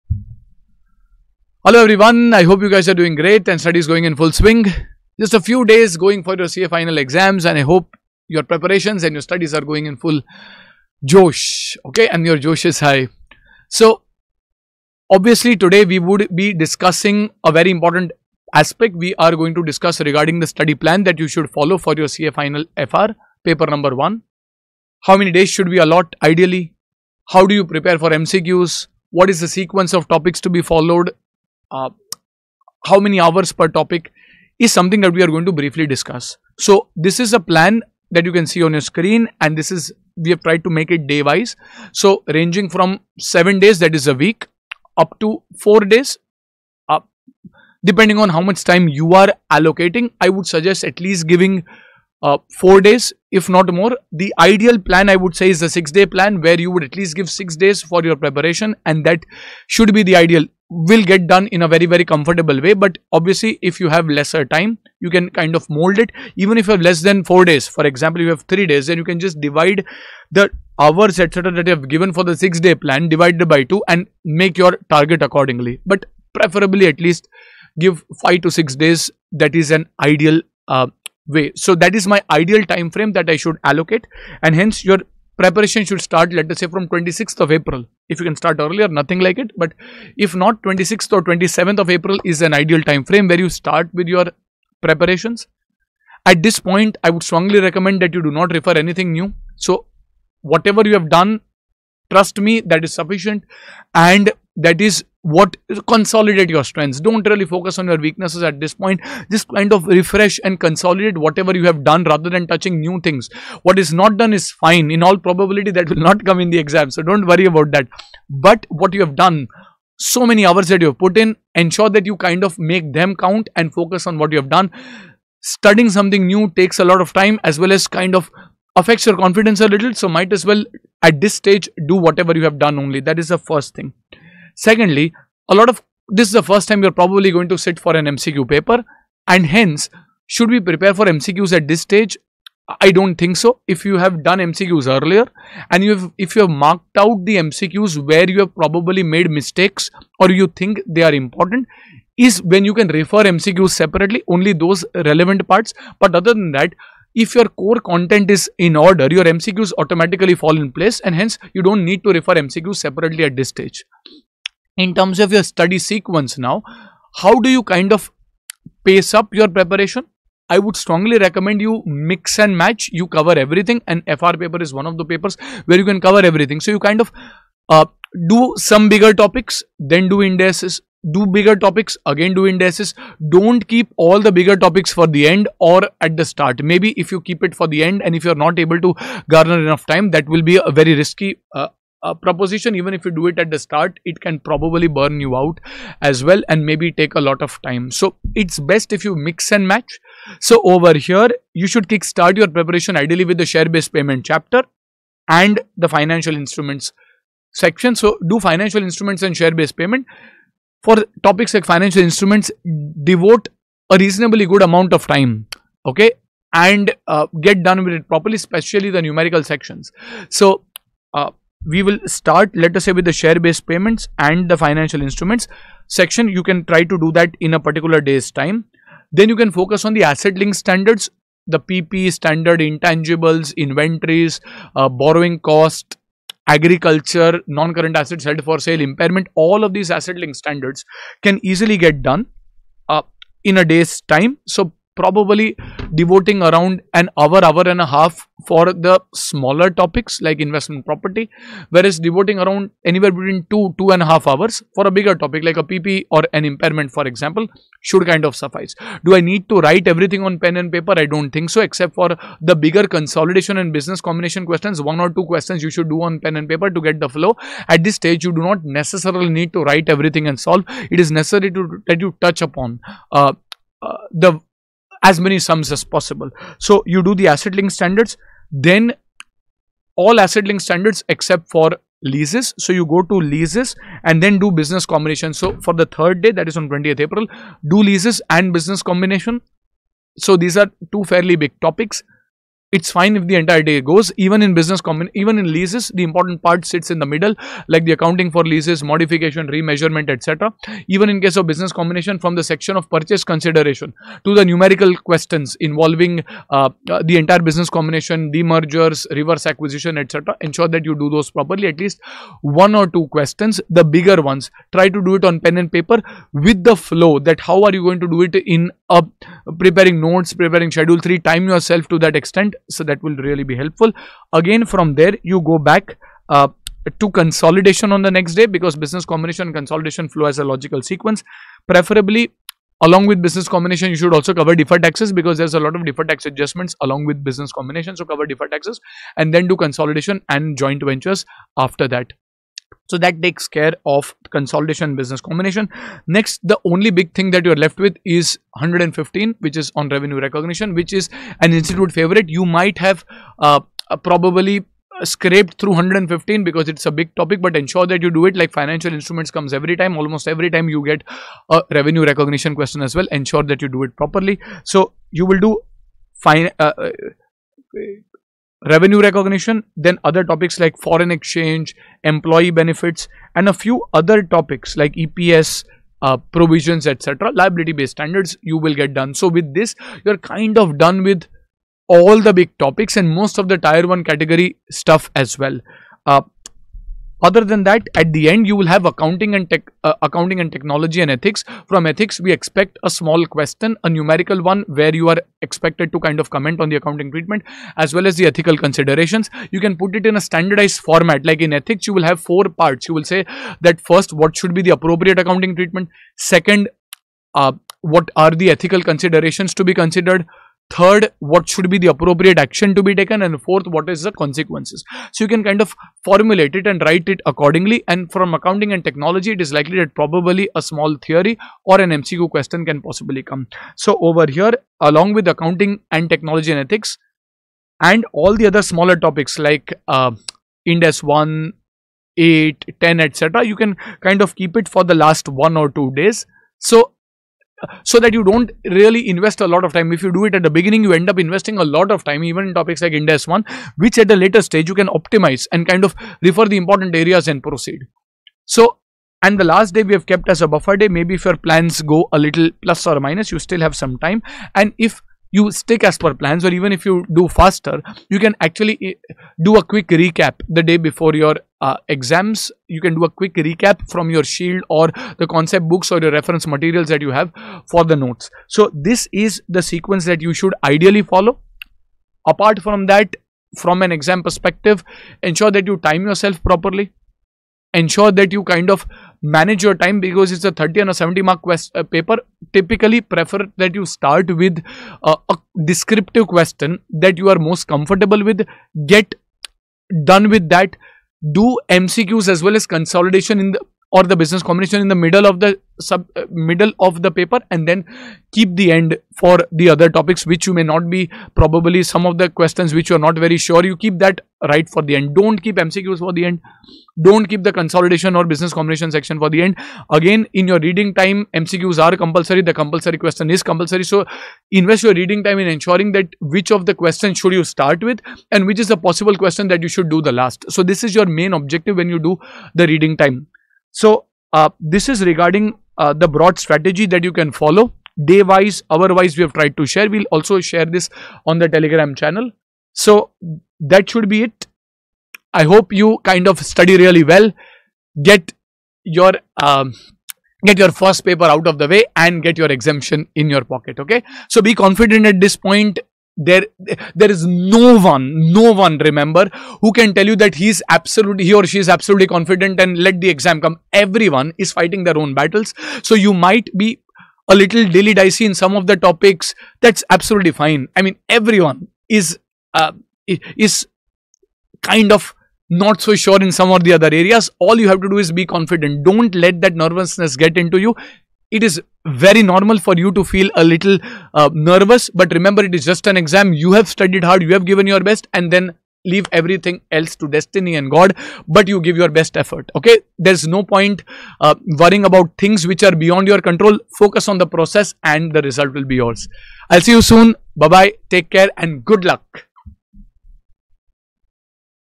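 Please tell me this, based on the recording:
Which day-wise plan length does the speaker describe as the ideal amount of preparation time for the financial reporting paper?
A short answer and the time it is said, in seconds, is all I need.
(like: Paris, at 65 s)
6 days, at 55 s.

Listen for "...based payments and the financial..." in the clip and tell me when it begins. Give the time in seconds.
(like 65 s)
223 s.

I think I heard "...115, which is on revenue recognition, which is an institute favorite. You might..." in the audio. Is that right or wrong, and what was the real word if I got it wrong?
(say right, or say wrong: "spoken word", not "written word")
right.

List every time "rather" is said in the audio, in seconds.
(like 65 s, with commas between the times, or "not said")
112 s.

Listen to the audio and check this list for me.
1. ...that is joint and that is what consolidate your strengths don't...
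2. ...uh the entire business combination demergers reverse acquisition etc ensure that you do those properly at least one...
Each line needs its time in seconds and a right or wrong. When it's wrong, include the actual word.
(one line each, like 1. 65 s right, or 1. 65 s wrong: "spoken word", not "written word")
1. 102 s wrong: "sufficient", not "joint"
2. 306 s right.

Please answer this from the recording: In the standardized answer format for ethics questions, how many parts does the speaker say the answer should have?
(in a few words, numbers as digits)
4.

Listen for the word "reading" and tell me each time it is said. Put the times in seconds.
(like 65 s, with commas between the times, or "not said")
510 s, 514 s, 522 s.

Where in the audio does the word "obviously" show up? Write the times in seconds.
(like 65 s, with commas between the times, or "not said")
15 s, 63 s.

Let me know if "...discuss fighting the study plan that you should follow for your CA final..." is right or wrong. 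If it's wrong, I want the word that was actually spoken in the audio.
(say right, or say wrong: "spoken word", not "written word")
wrong: "regarding", not "fighting".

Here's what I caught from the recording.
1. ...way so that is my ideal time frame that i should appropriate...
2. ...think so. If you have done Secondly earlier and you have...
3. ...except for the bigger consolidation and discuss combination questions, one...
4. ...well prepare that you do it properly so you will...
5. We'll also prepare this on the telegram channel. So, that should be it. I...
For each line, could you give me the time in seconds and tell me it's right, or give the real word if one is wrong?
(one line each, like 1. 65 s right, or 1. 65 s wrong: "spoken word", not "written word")
1. 81 s wrong: "allocate", not "appropriate"
2. 143 s wrong: "MCQs", not "Secondly"
3. 261 s wrong: "business", not "discuss"
4. 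362 s wrong: "ensure", not "prepare"
5. 529 s wrong: "share", not "prepare".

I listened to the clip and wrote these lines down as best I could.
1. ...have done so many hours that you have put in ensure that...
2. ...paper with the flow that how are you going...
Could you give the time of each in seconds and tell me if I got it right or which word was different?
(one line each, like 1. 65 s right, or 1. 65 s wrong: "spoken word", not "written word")
1. 119 s right
2. 315 s right.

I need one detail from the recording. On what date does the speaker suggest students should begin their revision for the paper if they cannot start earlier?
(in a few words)
26th of April.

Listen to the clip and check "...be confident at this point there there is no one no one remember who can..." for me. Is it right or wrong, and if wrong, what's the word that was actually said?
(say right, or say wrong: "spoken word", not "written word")
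right.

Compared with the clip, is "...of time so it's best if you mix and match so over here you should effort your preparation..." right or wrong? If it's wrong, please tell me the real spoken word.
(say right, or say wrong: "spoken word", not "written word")
wrong: "kickstart", not "effort".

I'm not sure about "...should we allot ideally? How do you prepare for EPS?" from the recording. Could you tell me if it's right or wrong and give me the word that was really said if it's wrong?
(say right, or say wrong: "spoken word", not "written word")
wrong: "MCQs", not "EPS".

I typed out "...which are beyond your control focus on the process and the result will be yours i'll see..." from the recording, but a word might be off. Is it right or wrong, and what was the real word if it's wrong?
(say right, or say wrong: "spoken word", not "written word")
right.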